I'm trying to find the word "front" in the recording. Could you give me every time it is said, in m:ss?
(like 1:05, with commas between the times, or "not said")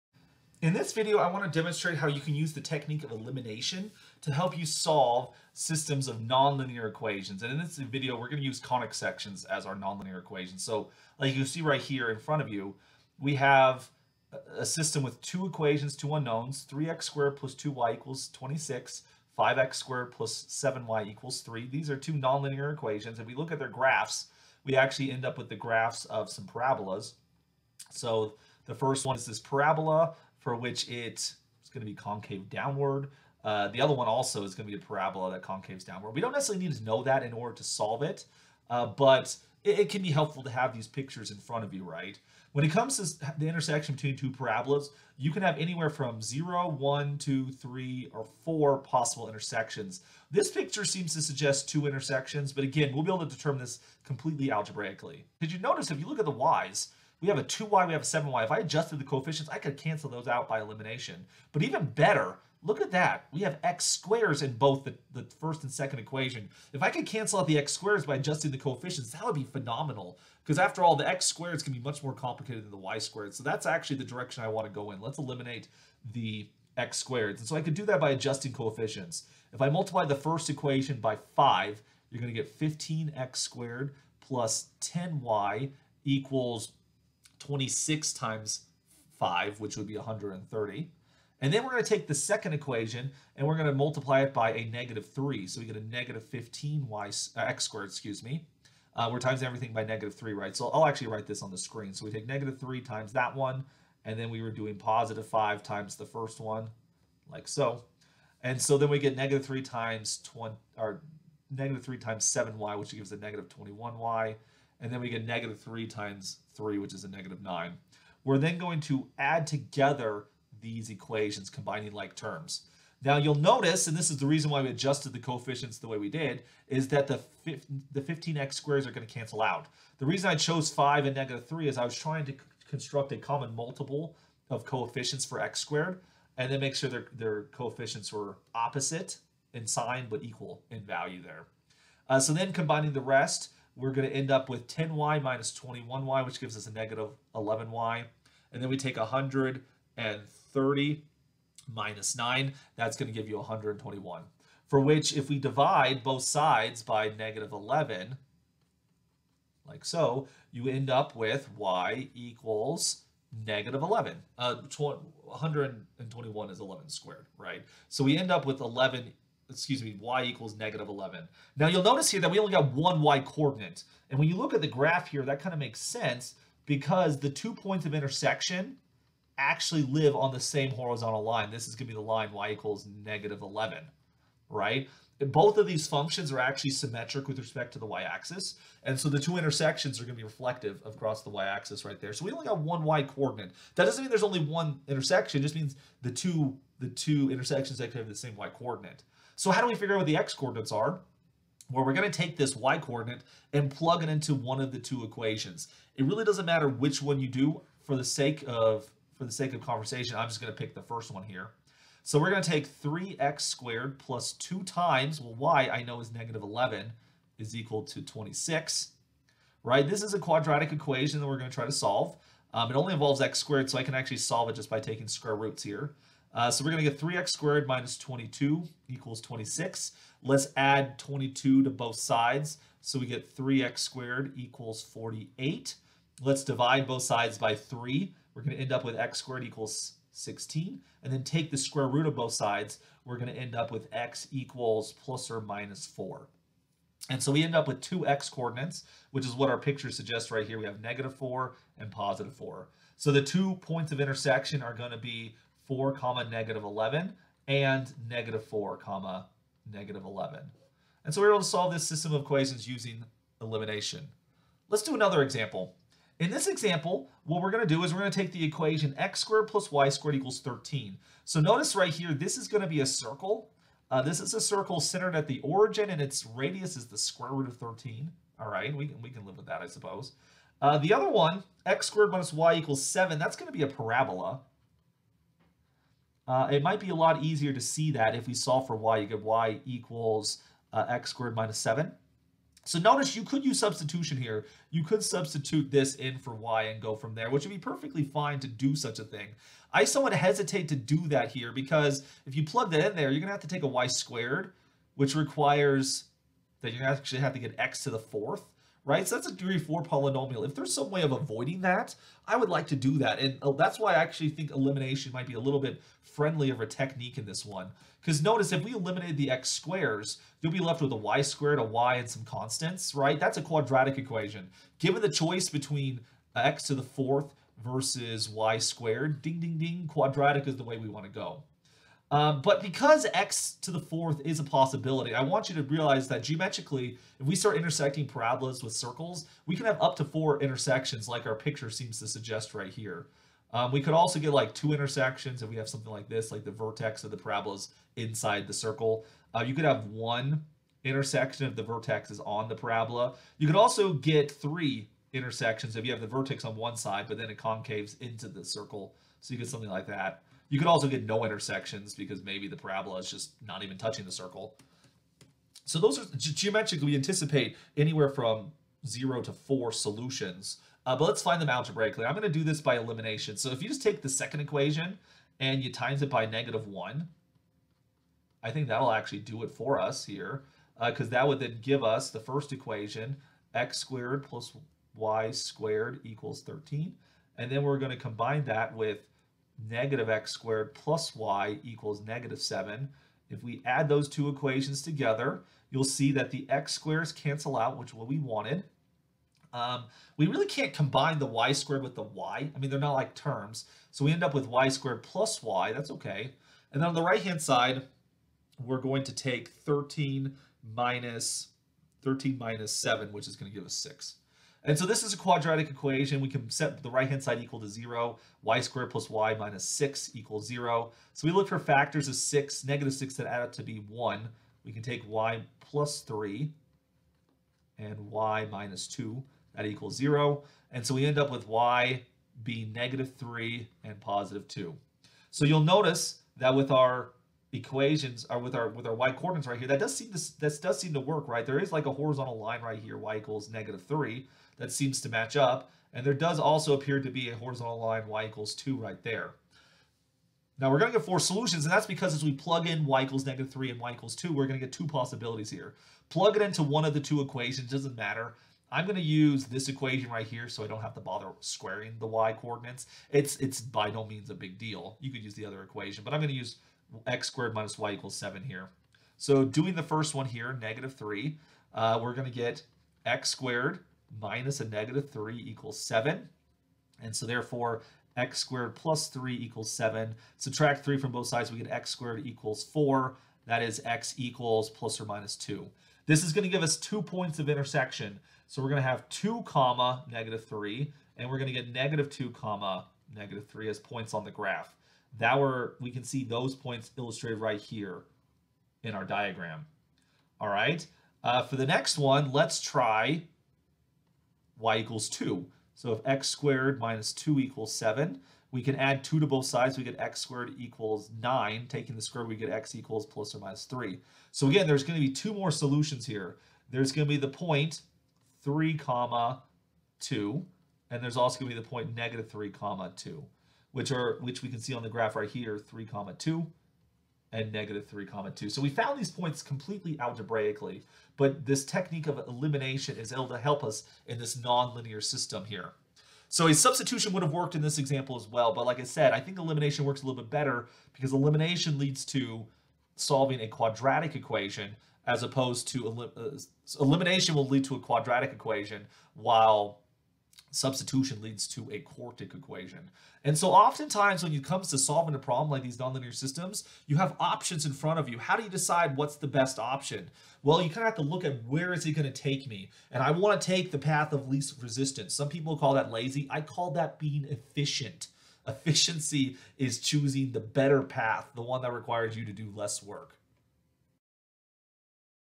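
0:12, 0:41, 9:17.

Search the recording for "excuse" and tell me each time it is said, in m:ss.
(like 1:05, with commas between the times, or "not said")
1:37, 2:49.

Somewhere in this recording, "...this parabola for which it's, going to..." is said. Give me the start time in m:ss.
0:29.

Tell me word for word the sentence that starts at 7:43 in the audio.
It's it's by no means a big deal.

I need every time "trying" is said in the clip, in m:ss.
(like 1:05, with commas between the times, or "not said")
2:11.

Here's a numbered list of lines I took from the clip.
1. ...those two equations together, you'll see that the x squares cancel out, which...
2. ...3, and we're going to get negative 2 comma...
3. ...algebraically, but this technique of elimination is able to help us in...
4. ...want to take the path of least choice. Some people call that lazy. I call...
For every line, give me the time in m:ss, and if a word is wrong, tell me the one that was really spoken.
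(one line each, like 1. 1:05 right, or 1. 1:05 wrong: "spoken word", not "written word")
1. 6:33 right
2. 8:10 right
3. 8:49 right
4. 9:23 wrong: "resistance", not "choice".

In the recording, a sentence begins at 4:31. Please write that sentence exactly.
So notice right here, this is going to be a circle.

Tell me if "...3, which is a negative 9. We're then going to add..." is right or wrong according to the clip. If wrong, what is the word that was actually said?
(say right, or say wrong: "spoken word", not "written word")
right.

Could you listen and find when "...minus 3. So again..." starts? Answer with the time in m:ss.
8:33.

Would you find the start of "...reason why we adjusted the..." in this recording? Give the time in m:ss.
2:04.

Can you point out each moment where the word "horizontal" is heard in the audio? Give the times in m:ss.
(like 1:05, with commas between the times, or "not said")
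3:00, 7:21, 7:27.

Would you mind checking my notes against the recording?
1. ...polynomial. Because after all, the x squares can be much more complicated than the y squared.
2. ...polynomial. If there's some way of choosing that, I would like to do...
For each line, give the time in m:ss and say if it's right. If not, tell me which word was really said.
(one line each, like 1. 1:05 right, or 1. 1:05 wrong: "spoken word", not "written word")
1. 1:09 wrong: "phenomenal", not "polynomial"
2. 5:09 wrong: "avoiding", not "choosing".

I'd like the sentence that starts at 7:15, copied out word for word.
So you'll notice that with our equations are with our with our y coordinates right here.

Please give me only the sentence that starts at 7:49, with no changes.
So doing the first one here, negative 3, uh, we're going to get x squared minus a negative 3 equals 7.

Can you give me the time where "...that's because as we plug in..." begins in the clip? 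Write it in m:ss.
7:31.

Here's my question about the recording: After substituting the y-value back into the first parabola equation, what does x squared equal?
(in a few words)
16.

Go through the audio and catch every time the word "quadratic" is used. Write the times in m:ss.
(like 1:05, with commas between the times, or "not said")
3:40, 5:23, 5:29, 6:55, 9:03, 9:07.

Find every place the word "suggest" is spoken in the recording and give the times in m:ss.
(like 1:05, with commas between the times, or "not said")
0:51, 4:09, 5:42.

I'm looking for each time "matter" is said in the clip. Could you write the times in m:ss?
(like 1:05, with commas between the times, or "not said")
3:26, 7:37.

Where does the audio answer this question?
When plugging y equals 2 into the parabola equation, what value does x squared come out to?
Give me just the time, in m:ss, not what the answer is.
8:29.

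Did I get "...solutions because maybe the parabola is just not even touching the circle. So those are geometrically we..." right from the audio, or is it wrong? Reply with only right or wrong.
wrong.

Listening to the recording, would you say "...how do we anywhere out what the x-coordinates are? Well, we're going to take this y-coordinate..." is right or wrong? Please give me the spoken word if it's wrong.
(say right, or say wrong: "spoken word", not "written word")
wrong: "figure", not "anywhere".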